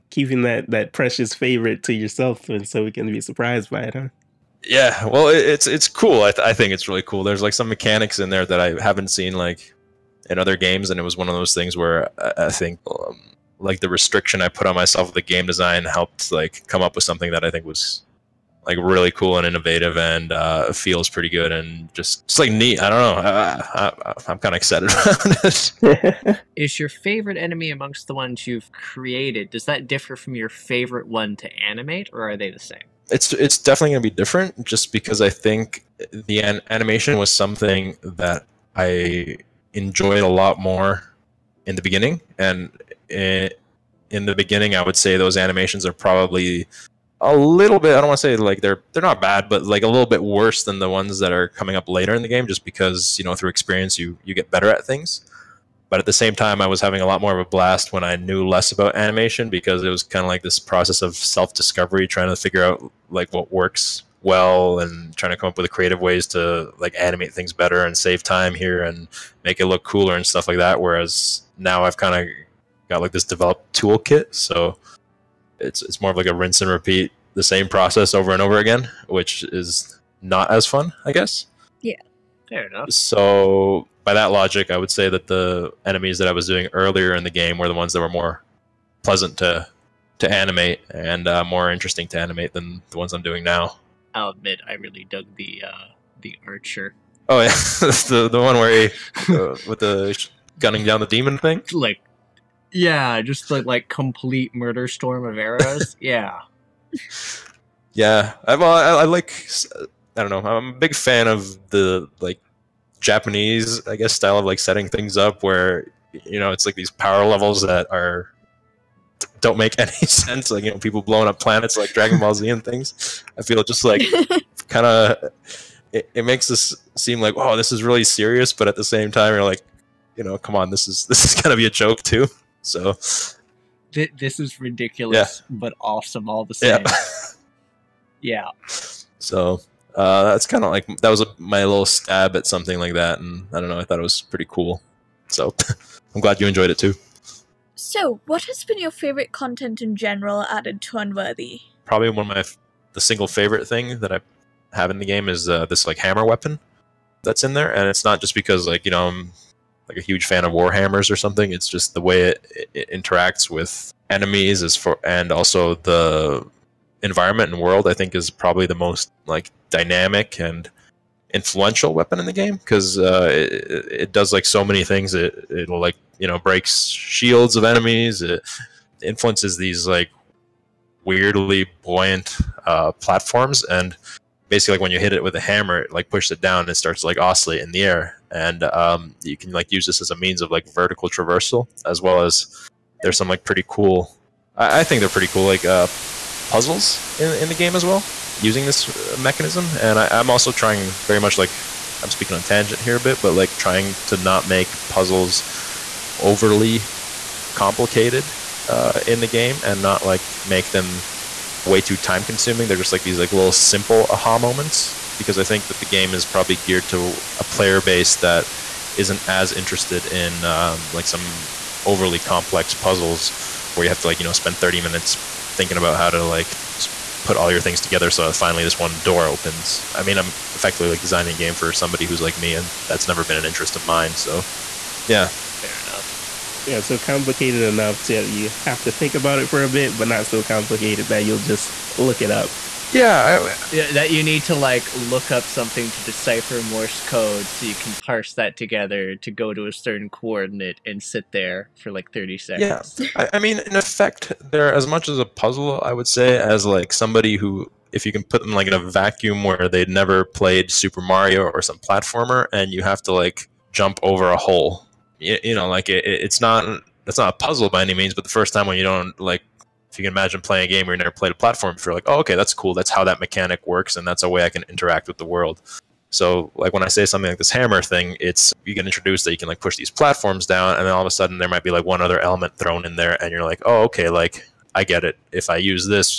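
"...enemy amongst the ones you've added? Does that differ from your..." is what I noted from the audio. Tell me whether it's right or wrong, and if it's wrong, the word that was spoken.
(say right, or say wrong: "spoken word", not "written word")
wrong: "created", not "added".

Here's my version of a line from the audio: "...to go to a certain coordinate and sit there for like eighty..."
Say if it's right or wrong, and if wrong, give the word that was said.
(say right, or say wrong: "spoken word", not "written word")
wrong: "thirty", not "eighty".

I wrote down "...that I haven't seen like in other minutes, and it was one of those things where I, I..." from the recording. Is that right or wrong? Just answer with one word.
wrong.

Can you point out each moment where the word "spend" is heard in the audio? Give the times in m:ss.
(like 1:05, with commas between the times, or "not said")
3:44.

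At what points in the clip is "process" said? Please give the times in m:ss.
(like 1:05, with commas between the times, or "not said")
1:00, 1:17.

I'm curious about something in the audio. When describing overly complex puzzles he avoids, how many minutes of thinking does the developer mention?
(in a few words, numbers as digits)
30.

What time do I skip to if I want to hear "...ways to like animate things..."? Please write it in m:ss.
1:05.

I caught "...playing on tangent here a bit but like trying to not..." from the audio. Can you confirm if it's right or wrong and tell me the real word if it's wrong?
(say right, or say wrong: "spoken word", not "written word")
wrong: "speaking", not "playing".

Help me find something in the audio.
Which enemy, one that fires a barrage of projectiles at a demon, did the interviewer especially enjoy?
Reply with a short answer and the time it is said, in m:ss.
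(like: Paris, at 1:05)
The archer, at 1:36.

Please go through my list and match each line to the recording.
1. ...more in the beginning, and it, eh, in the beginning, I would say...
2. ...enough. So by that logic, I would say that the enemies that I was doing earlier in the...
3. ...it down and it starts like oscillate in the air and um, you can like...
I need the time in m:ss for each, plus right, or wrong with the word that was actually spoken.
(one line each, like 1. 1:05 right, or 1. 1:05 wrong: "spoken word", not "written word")
1. 0:40 right
2. 1:22 right
3. 3:06 right.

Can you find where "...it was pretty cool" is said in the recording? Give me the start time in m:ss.
2:23.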